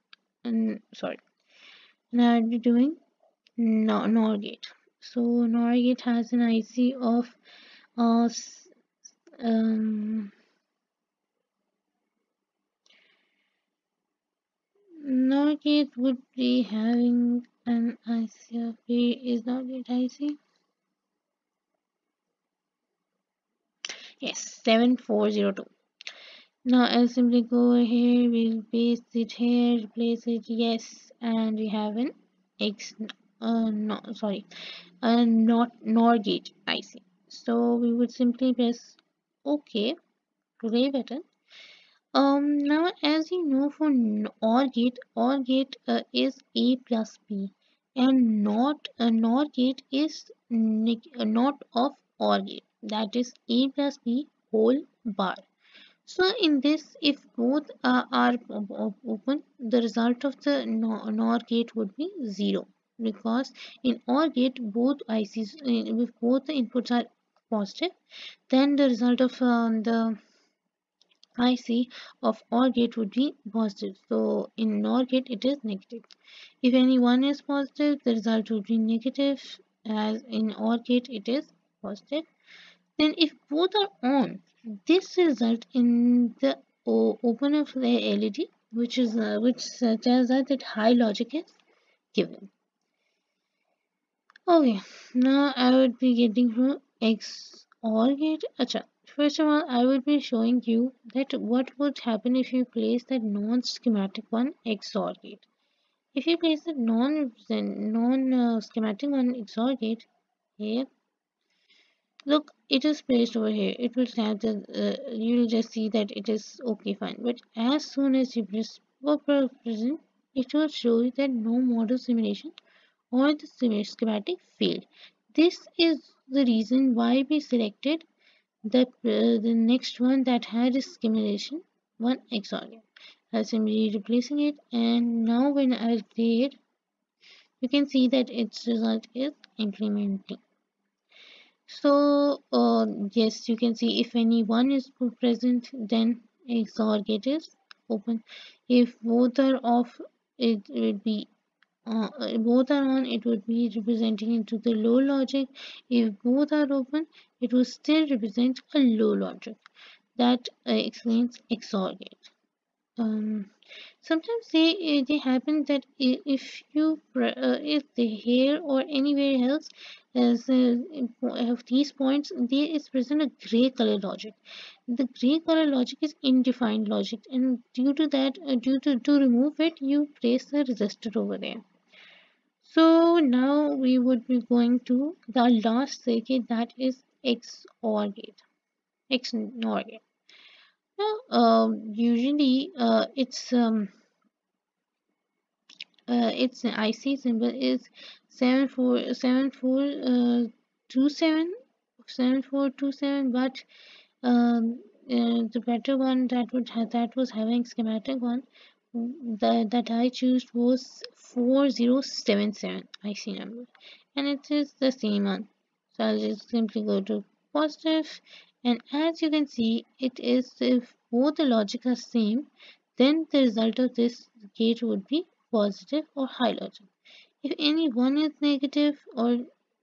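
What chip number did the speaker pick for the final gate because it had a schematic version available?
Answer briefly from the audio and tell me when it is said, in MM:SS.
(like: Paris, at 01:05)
4077, at 03:31.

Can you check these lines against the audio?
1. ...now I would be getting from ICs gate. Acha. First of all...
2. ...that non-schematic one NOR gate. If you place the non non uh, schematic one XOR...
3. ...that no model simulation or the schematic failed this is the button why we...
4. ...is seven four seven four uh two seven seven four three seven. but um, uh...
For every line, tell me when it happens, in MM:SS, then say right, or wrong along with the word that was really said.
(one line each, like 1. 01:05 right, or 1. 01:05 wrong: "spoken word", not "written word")
1. 01:35 wrong: "XOR", not "ICs"
2. 01:43 wrong: "XOR", not "NOR"
3. 02:01 wrong: "reason", not "button"
4. 03:17 wrong: "two", not "three".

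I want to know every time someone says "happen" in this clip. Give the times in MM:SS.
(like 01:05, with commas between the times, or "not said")
01:41, 02:45.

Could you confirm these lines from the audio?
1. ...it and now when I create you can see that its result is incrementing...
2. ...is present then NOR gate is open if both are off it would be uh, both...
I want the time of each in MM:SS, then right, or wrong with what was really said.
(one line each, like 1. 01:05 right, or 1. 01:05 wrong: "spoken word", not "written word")
1. 02:14 right
2. 02:24 wrong: "XOR", not "NOR".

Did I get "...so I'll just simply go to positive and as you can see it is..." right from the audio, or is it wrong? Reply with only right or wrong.
right.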